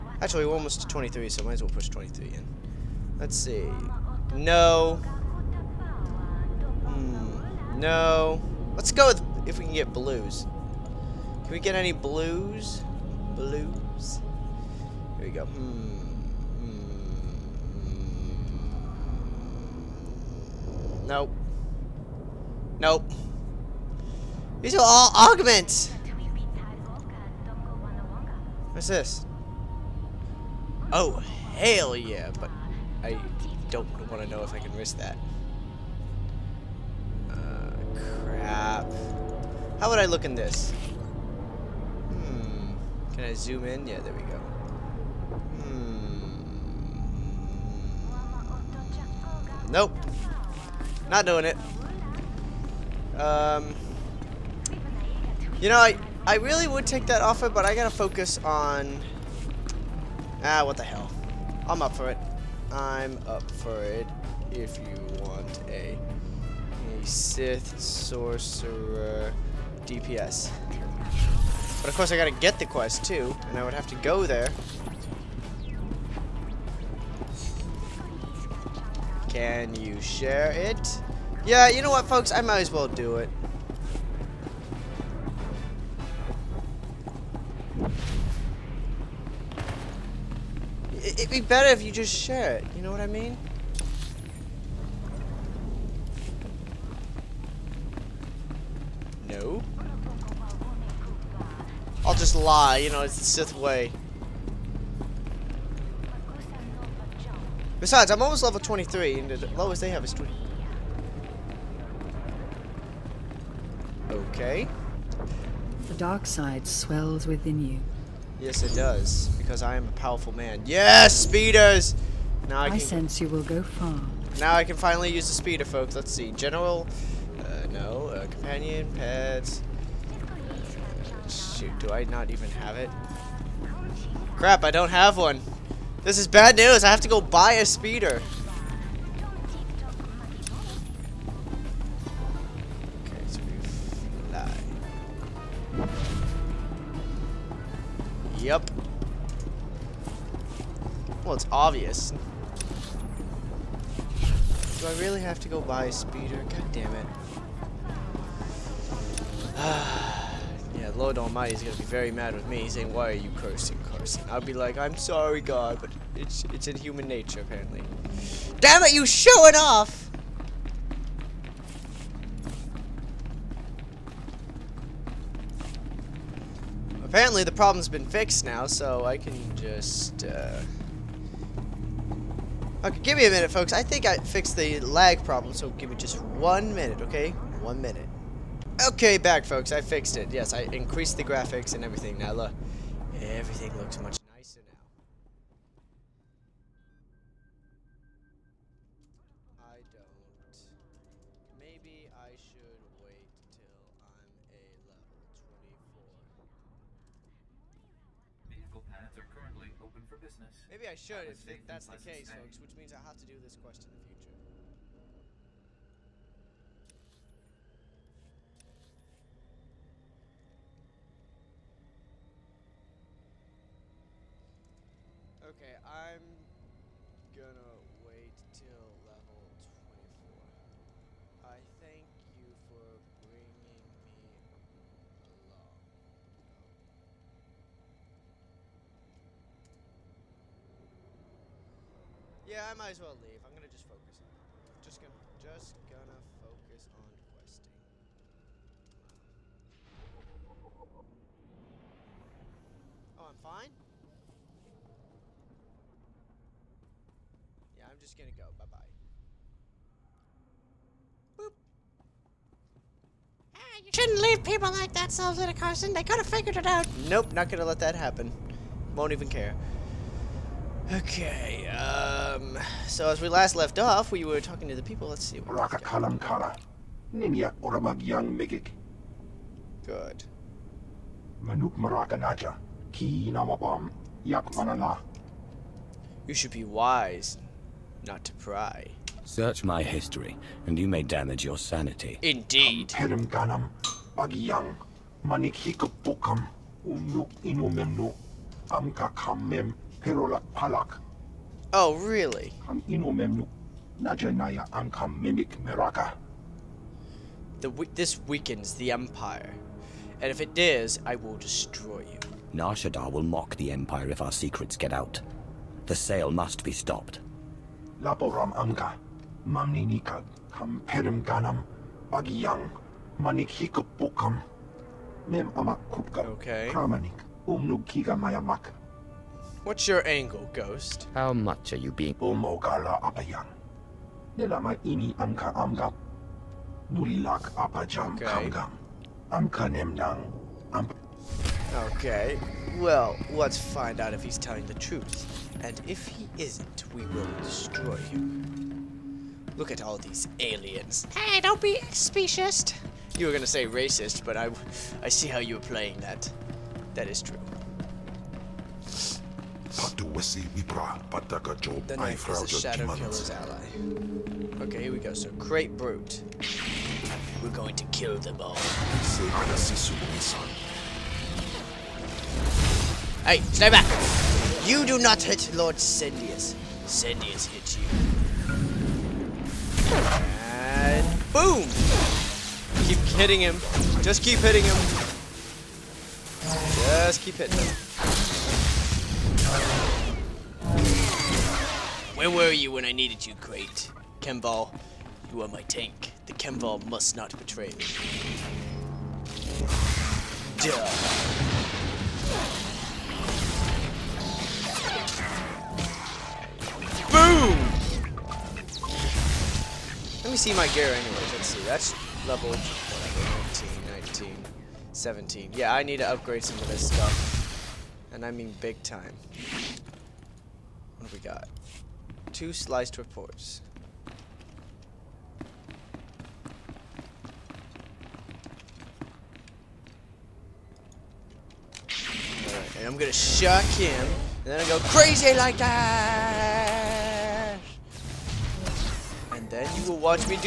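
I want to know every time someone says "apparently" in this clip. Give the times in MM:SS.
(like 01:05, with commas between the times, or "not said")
02:47, 02:57.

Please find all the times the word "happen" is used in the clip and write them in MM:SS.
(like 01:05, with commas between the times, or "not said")
04:27.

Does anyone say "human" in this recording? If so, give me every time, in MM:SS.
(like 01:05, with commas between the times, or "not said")
02:46.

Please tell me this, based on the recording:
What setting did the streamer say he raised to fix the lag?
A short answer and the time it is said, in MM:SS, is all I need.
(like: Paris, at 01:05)
The graphics, at 03:10.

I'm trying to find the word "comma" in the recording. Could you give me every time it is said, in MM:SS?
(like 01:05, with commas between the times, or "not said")
not said.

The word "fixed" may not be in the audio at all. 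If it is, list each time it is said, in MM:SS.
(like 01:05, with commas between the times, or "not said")
02:58, 03:04, 03:09.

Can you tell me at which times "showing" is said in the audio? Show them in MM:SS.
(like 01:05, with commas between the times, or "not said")
02:49.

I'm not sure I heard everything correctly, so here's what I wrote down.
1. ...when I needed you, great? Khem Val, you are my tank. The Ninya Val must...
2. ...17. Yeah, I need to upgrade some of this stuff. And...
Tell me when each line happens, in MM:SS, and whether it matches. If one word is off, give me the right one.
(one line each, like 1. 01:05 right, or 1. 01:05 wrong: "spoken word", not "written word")
1. 06:32 wrong: "Khem", not "Ninya"
2. 06:54 right.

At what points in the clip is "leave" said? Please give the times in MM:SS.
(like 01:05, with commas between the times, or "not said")
04:03, 04:24.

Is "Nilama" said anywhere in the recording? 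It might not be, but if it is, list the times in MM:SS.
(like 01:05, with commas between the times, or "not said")
05:34.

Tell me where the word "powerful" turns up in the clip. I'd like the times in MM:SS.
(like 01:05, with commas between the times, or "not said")
01:59.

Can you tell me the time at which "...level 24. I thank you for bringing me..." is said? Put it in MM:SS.
03:49.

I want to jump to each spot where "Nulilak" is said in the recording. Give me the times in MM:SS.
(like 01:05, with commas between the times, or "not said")
05:36.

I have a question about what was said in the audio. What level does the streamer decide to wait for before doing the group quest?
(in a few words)
24.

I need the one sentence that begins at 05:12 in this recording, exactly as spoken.
Nar Shaddaa will mock the Empire if our secrets get out.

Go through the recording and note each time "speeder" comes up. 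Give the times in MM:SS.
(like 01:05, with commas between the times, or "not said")
02:01, 02:05, 02:17, 02:35.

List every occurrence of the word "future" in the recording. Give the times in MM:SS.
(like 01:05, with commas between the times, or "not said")
03:34.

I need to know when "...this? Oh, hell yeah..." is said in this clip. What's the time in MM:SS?
00:28.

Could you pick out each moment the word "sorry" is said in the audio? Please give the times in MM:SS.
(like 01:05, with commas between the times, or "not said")
02:44.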